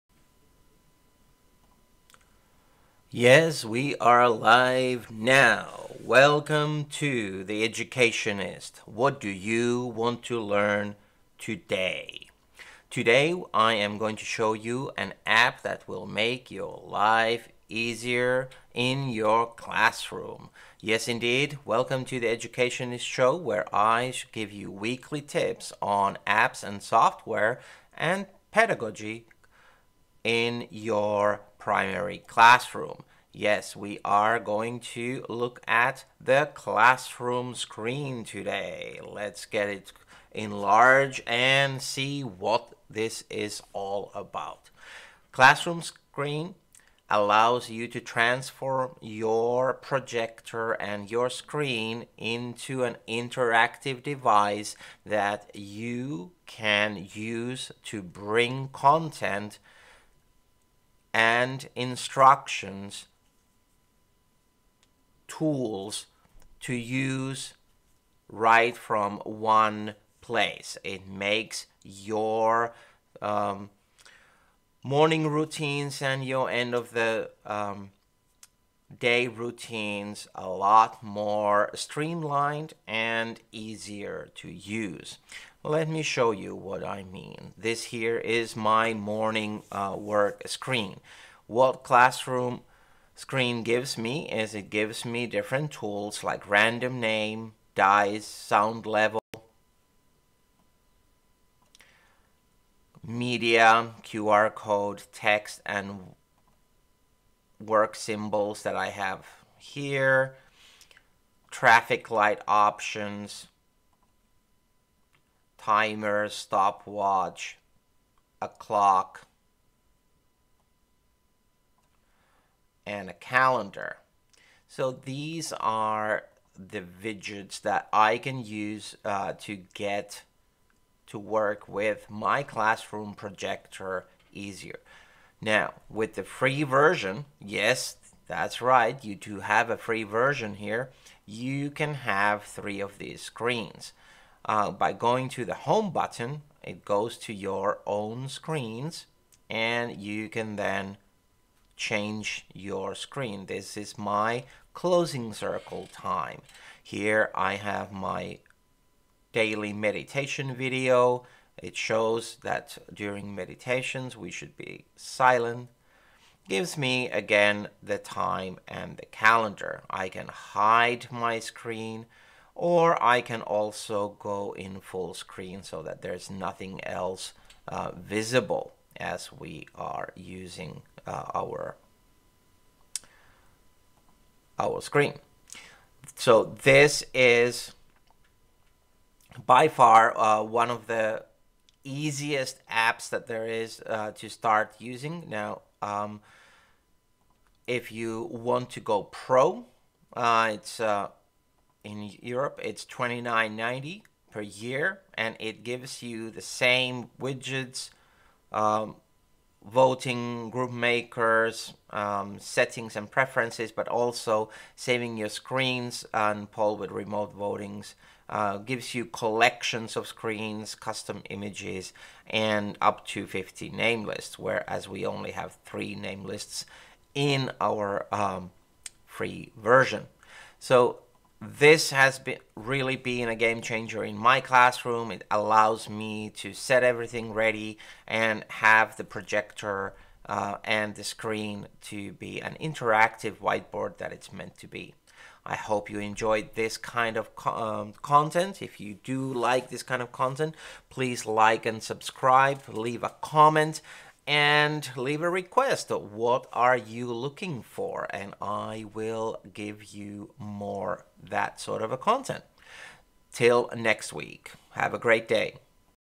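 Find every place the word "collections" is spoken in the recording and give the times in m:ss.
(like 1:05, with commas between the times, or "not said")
3:39.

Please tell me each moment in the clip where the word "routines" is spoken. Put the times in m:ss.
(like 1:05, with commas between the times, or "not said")
1:15, 1:19.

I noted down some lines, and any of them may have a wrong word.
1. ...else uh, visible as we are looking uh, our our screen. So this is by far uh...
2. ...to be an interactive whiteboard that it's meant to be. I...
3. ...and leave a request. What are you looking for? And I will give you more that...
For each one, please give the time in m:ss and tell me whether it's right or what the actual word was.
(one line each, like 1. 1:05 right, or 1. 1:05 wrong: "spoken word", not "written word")
1. 2:56 wrong: "using", not "looking"
2. 4:01 right
3. 4:14 right.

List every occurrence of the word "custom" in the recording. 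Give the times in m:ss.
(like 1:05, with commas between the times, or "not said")
3:40.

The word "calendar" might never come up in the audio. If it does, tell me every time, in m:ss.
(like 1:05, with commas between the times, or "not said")
2:03, 2:49.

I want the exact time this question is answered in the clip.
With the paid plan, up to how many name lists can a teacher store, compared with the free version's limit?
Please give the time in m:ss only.
3:43.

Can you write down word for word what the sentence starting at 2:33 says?
This is my closing circle time.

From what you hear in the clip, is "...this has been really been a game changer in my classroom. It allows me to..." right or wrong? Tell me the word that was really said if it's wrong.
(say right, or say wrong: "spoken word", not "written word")
right.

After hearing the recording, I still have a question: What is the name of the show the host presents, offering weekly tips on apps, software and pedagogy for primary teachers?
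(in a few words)
The Educationist Show.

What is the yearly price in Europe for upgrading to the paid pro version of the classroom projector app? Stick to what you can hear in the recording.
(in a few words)
29.90.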